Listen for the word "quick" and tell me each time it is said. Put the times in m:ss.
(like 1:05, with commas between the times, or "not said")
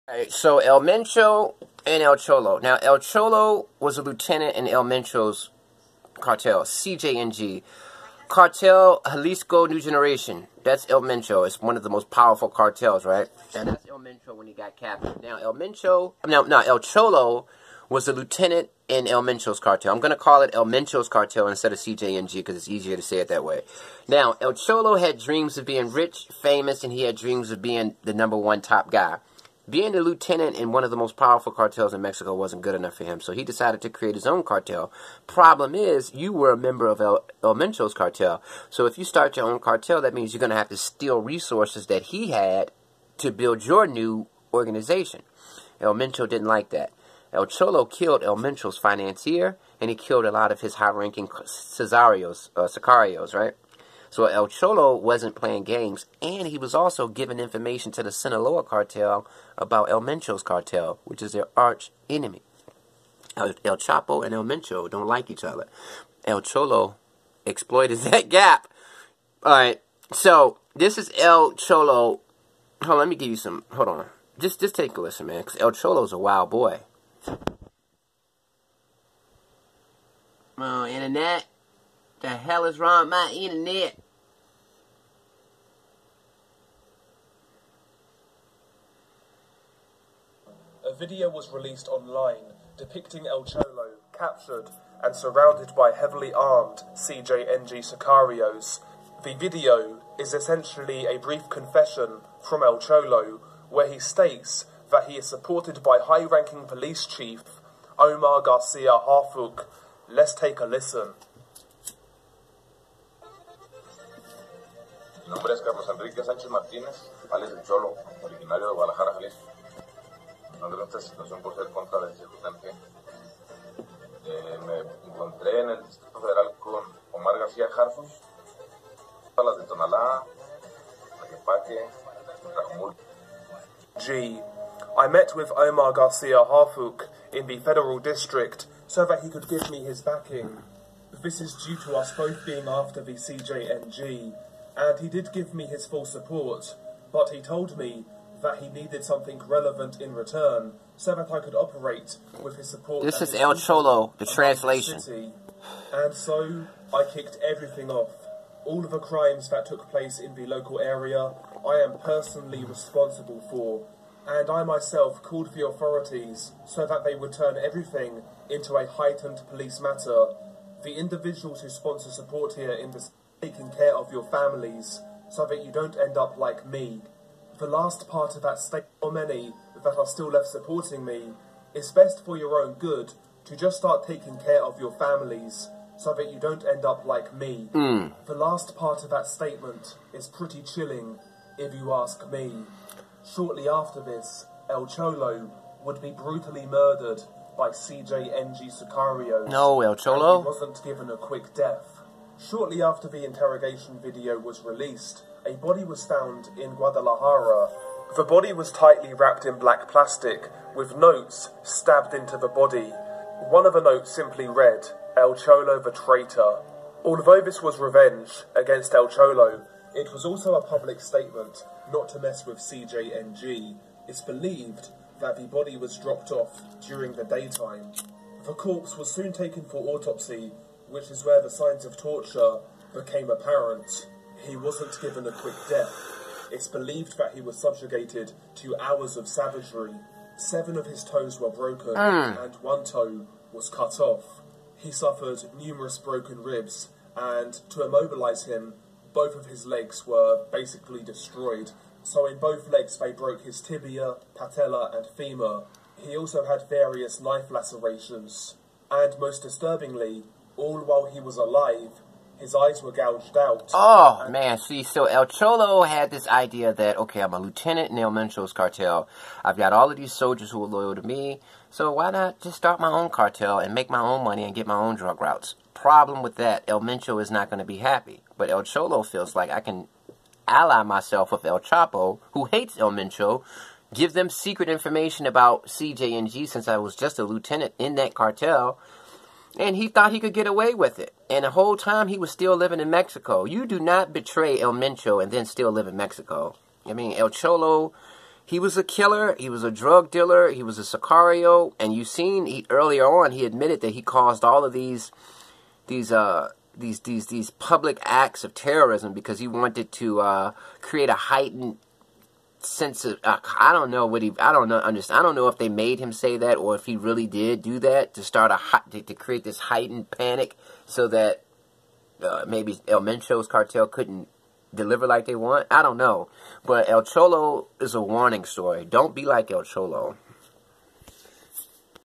3:21, 3:55.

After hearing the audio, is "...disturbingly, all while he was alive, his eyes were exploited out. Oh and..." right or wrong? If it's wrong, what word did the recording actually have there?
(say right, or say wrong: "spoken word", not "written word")
wrong: "gouged", not "exploited".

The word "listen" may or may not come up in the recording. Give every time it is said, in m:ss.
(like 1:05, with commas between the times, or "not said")
1:15, 1:50.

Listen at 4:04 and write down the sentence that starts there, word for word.
He suffered numerous broken ribs, and to immobilize him, both of his legs were basically destroyed.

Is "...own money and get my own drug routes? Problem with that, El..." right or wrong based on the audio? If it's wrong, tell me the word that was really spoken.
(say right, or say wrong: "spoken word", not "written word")
right.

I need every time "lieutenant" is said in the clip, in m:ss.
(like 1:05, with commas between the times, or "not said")
0:04, 0:18, 0:29, 4:27, 4:47.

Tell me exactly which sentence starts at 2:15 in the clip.
I met with Omar Garcia Harfuch in the federal district so that he could give me his backing.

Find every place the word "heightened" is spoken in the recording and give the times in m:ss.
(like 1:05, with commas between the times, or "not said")
2:48, 5:11, 5:19.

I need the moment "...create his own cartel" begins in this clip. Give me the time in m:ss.
0:33.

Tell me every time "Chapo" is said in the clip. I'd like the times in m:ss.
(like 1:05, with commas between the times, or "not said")
1:03, 4:41.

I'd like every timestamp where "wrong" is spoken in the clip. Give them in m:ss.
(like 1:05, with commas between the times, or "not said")
1:22.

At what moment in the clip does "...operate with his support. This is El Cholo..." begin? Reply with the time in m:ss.
2:31.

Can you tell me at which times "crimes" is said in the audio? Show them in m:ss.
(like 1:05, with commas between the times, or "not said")
2:38.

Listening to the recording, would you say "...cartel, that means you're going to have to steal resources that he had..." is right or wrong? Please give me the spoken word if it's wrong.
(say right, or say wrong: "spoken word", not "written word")
right.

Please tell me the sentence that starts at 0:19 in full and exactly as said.
I'm going to call it El Mencho's cartel instead of CJNG because it's easier to say it that way.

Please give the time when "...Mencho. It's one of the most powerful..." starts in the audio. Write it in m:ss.
0:11.